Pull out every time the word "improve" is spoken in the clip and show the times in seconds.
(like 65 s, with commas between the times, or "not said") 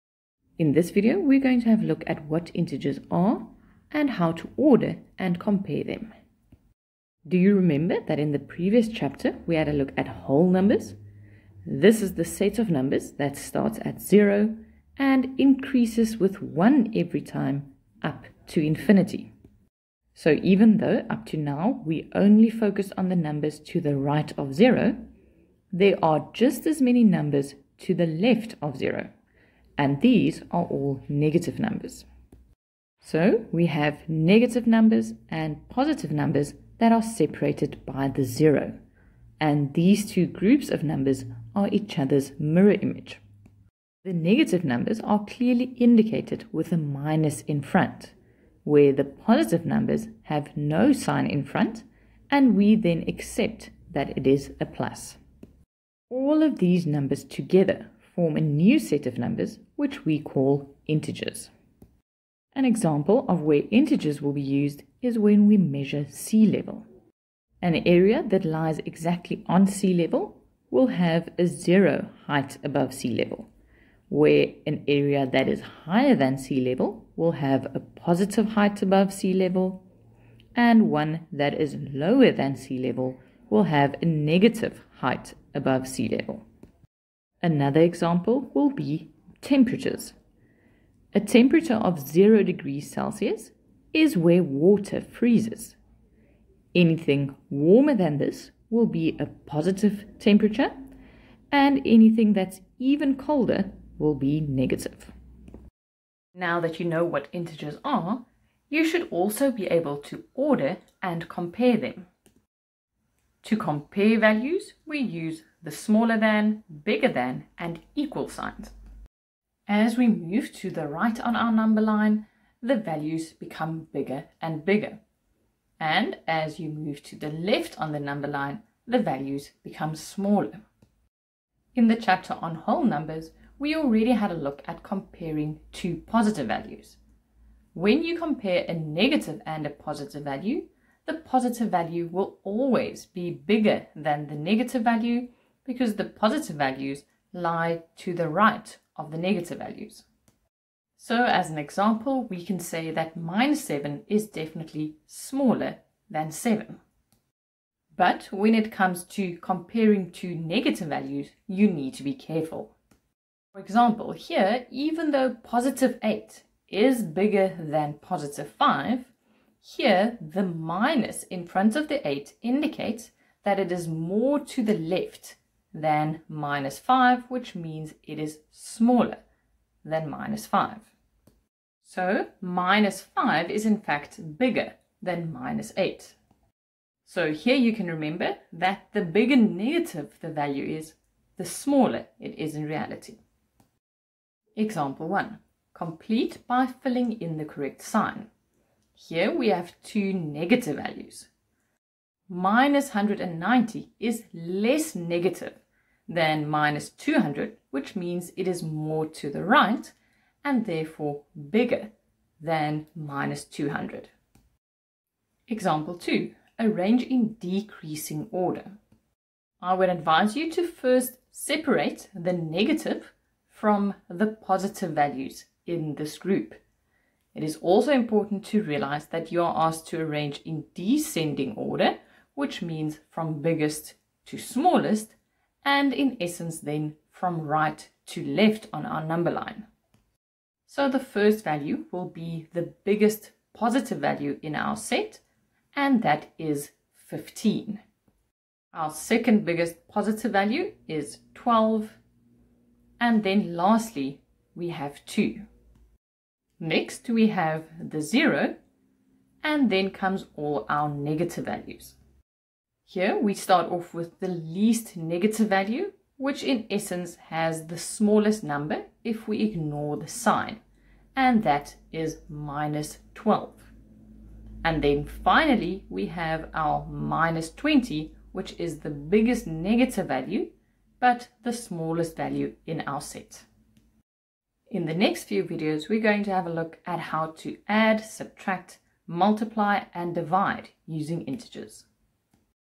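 not said.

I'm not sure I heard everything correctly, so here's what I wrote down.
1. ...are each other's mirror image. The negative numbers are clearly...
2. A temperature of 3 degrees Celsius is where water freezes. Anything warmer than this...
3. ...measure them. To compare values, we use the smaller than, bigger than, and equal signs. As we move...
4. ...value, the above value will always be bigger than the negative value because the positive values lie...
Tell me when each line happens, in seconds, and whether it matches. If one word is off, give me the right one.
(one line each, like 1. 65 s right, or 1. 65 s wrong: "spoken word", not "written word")
1. 41 s right
2. 91 s wrong: "0", not "3"
3. 111 s wrong: "compare", not "measure"
4. 140 s wrong: "positive", not "above".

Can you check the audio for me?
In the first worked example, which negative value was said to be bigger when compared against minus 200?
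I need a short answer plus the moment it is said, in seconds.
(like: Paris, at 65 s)
-190, at 202 s.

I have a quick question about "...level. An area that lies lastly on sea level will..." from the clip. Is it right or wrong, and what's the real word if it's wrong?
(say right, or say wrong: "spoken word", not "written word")
wrong: "exactly", not "lastly".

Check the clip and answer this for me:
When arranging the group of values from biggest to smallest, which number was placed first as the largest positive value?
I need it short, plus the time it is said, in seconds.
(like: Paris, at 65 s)
15, at 247 s.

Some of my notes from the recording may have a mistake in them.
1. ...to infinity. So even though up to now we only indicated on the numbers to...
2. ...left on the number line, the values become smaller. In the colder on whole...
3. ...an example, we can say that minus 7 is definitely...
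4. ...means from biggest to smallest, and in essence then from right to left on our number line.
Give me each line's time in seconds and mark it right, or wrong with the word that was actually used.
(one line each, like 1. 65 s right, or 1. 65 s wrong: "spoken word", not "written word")
1. 18 s wrong: "focused", not "indicated"
2. 127 s wrong: "chapter", not "colder"
3. 151 s right
4. 232 s right.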